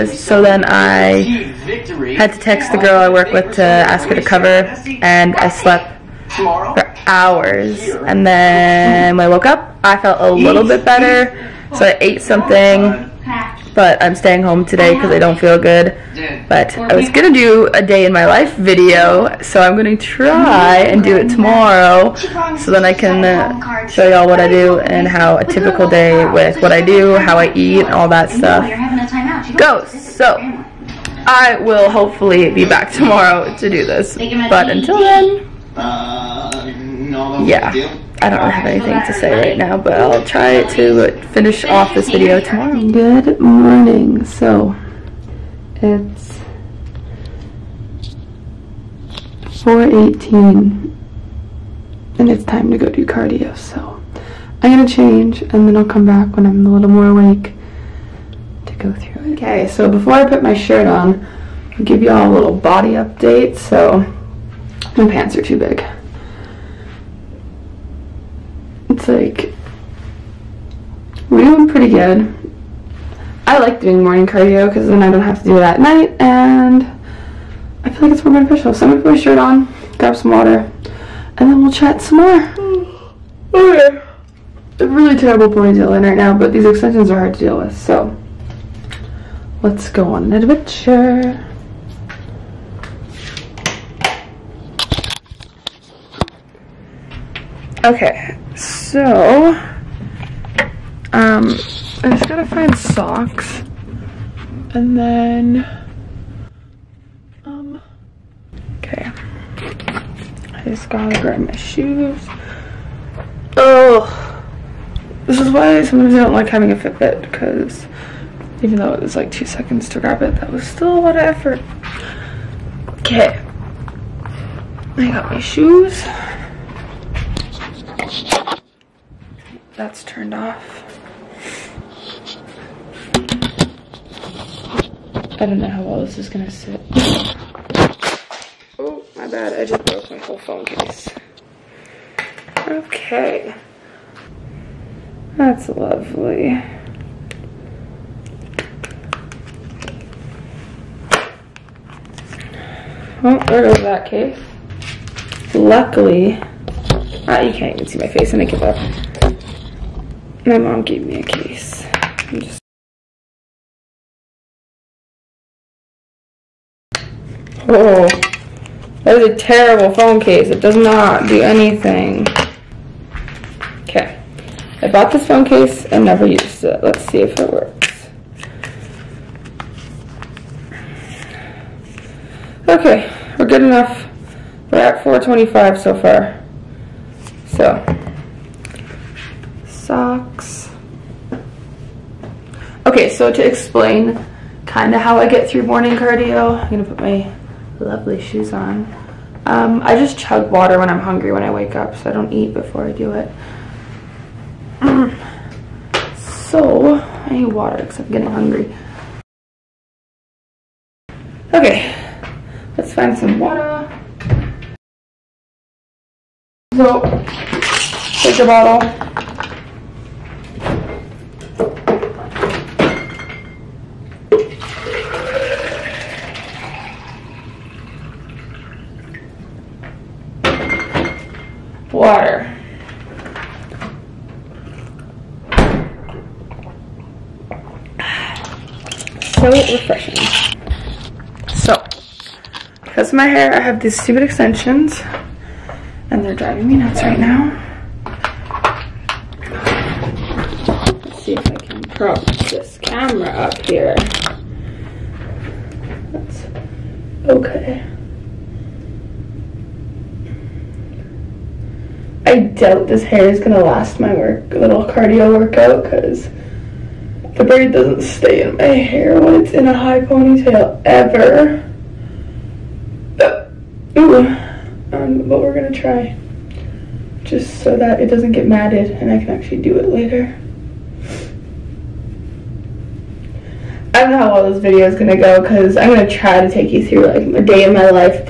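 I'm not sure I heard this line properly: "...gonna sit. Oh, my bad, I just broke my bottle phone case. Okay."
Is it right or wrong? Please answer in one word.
wrong.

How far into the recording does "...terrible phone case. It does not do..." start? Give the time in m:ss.
2:49.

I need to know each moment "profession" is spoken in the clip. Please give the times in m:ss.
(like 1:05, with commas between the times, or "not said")
not said.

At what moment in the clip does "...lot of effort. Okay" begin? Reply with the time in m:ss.
2:00.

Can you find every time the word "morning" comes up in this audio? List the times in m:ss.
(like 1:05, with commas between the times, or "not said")
0:43, 1:14, 3:15.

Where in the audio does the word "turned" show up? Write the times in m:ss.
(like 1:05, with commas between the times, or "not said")
2:10.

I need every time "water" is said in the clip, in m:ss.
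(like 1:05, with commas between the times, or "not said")
1:20, 3:20, 3:27, 3:33.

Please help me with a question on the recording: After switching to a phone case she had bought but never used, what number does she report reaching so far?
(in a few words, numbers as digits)
425.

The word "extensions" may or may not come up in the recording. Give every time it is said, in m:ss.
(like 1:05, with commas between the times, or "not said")
1:26, 4:04.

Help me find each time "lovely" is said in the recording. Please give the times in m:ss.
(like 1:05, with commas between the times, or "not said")
2:25, 3:17.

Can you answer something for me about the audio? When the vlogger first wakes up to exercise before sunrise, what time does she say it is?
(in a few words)
4:18.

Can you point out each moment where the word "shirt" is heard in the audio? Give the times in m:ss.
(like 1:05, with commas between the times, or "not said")
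1:00, 1:19.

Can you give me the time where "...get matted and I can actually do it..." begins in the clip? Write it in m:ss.
4:38.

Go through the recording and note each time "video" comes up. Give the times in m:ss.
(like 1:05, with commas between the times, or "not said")
0:18, 0:42, 4:44.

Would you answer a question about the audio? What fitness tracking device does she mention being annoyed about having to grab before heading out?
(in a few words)
Fitbit.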